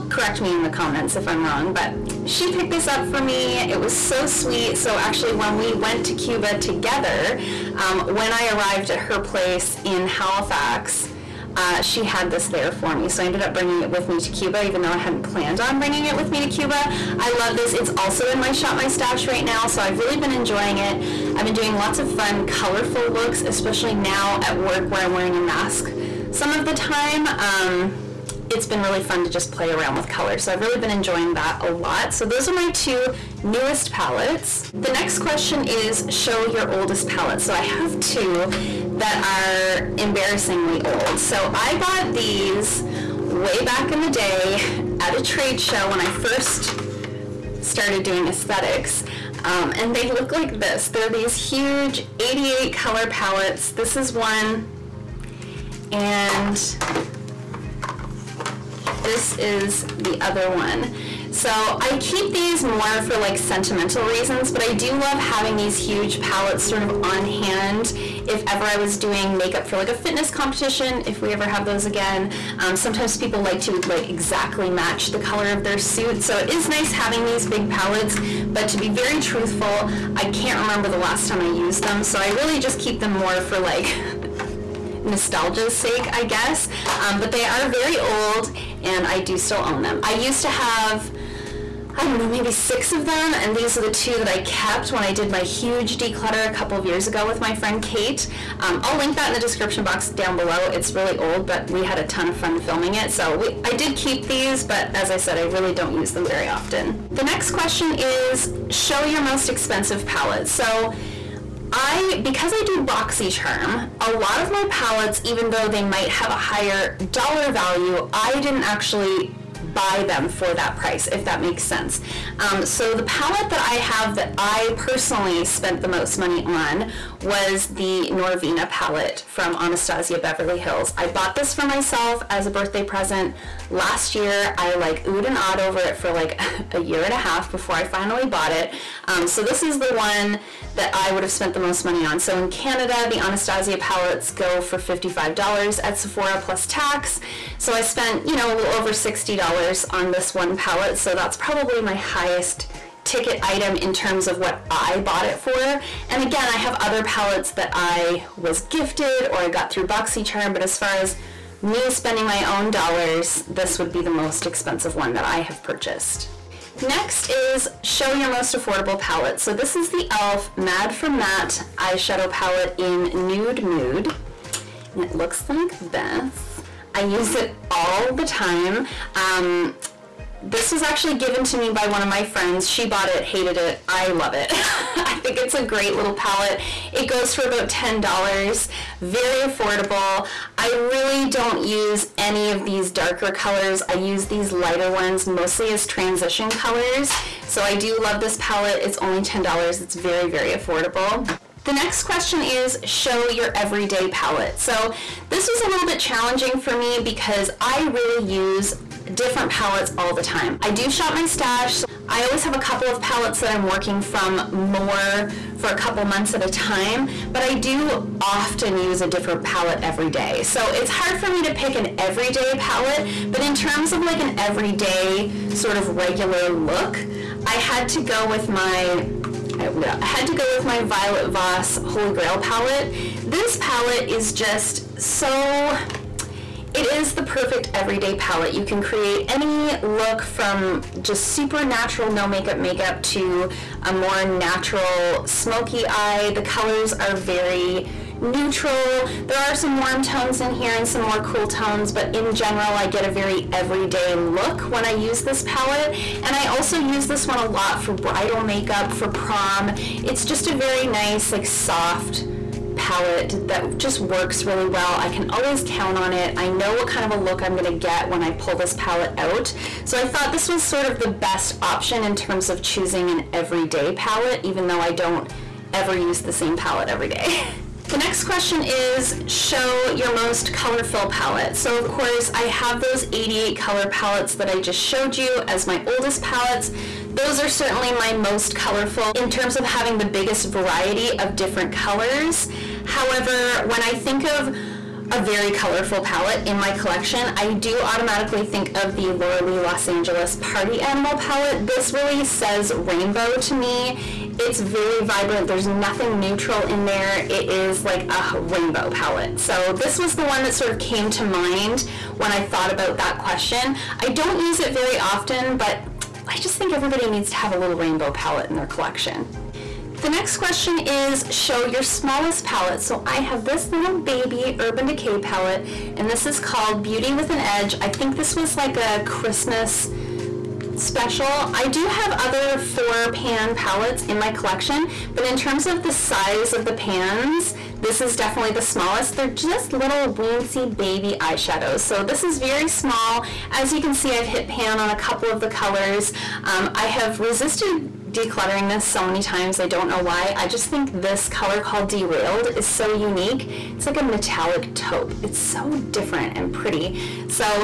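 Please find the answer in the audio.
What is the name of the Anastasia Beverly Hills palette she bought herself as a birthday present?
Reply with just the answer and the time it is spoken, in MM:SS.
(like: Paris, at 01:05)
Norvina, at 02:08.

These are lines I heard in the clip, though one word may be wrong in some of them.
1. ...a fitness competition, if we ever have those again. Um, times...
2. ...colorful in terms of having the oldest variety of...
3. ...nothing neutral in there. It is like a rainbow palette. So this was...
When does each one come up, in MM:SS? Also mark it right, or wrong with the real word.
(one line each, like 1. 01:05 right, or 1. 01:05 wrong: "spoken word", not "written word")
1. 01:09 wrong: "sometimes", not "times"
2. 04:48 wrong: "biggest", not "oldest"
3. 05:05 right.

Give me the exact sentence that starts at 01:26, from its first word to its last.
Um, but they are very old and I do still own them.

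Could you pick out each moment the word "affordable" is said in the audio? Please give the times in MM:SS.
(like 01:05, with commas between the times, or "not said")
02:48, 03:09, 03:20.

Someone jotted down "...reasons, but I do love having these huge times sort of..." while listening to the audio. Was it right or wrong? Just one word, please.
wrong.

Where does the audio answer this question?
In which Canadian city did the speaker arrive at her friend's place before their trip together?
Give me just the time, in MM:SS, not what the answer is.
00:10.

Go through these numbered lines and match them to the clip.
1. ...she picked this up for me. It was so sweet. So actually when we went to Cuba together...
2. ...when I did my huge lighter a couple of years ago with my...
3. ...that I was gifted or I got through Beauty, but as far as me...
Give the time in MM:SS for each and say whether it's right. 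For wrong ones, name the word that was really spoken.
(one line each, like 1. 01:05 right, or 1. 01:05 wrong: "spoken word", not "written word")
1. 00:02 right
2. 01:34 wrong: "declutter", not "lighter"
3. 02:37 wrong: "BoxyCharm", not "Beauty".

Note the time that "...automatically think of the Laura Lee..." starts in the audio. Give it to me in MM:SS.
04:57.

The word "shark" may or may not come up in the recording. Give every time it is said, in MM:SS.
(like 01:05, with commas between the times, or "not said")
not said.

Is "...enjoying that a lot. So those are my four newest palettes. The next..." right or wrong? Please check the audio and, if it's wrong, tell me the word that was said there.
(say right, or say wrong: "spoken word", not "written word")
wrong: "two", not "four".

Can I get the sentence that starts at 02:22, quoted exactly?
So in Canada, the Anastasia palettes go for $55 at Sephora plus tax.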